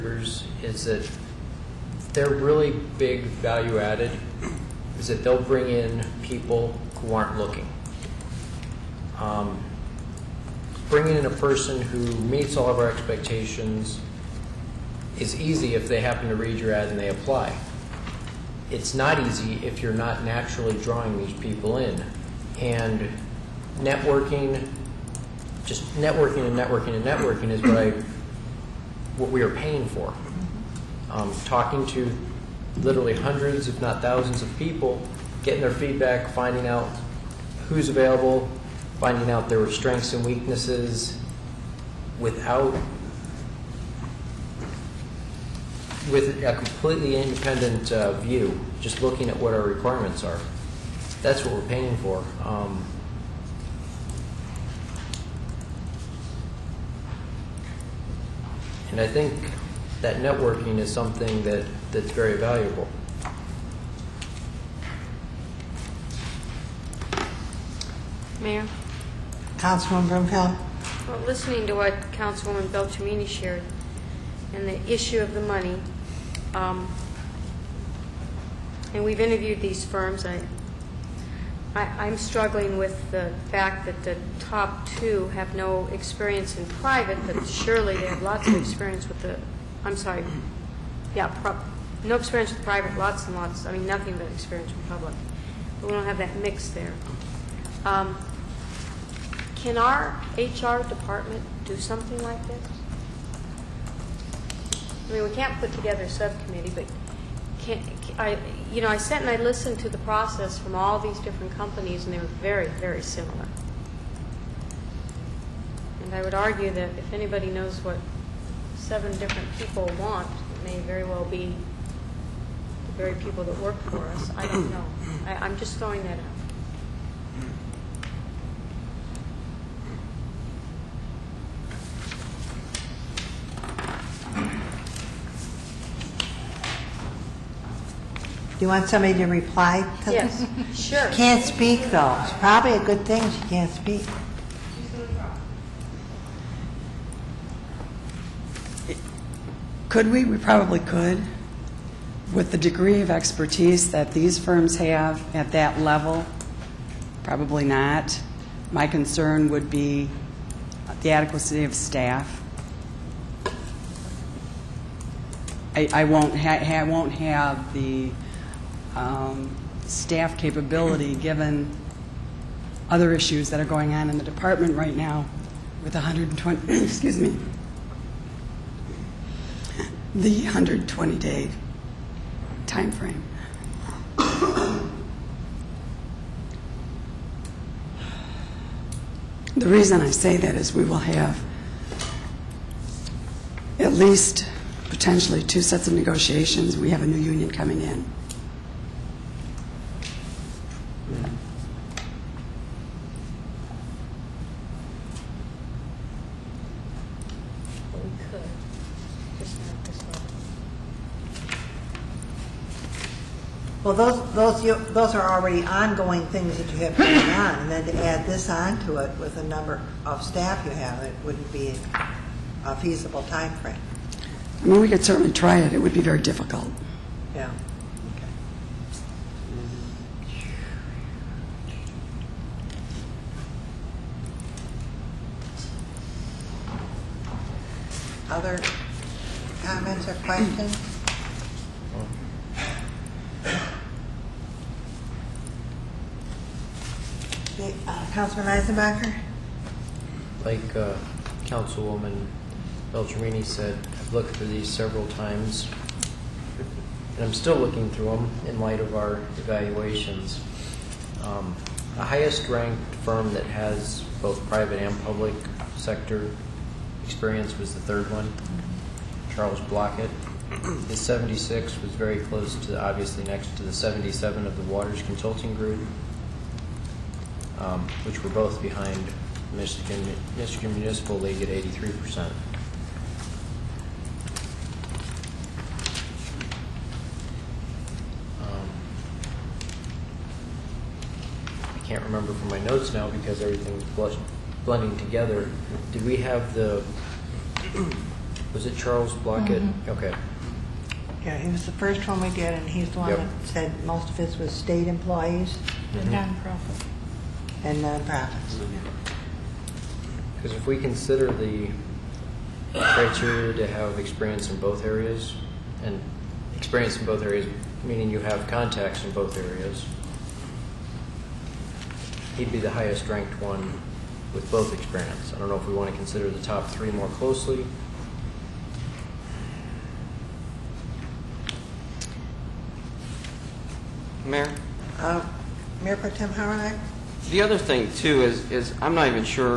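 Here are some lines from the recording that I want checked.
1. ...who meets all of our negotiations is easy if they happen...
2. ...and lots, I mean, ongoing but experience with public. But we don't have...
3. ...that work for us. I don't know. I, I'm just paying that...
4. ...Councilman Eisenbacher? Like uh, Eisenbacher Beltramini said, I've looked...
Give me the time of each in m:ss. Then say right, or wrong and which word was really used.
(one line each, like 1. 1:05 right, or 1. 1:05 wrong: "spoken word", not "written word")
1. 0:11 wrong: "expectations", not "negotiations"
2. 1:33 wrong: "nothing", not "ongoing"
3. 2:03 wrong: "throwing", not "paying"
4. 4:08 wrong: "Councilwoman", not "Eisenbacher".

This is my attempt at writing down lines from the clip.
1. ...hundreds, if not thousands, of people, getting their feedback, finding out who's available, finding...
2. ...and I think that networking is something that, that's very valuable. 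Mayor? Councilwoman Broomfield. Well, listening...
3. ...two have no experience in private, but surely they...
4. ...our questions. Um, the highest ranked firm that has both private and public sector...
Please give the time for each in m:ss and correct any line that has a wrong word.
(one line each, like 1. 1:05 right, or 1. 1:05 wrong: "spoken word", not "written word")
1. 0:33 right
2. 0:58 right
3. 1:24 right
4. 4:18 wrong: "evaluations", not "questions".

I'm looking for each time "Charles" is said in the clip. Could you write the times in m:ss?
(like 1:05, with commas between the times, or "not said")
4:29, 4:58.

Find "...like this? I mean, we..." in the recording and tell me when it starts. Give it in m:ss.
1:42.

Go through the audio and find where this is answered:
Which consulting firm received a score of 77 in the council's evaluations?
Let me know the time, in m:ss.
4:34.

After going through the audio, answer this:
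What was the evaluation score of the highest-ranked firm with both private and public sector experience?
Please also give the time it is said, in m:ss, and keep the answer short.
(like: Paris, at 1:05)
76, at 4:30.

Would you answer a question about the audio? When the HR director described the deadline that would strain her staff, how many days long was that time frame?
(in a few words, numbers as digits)
120.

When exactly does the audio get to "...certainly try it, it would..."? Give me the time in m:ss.
3:45.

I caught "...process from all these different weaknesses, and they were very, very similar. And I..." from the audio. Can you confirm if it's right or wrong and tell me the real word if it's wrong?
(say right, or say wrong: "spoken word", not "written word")
wrong: "companies", not "weaknesses".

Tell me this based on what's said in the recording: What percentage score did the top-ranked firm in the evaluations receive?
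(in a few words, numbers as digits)
83%.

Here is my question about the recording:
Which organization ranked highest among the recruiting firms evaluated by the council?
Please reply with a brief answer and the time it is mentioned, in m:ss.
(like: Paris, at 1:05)
Michigan Municipal League, at 4:40.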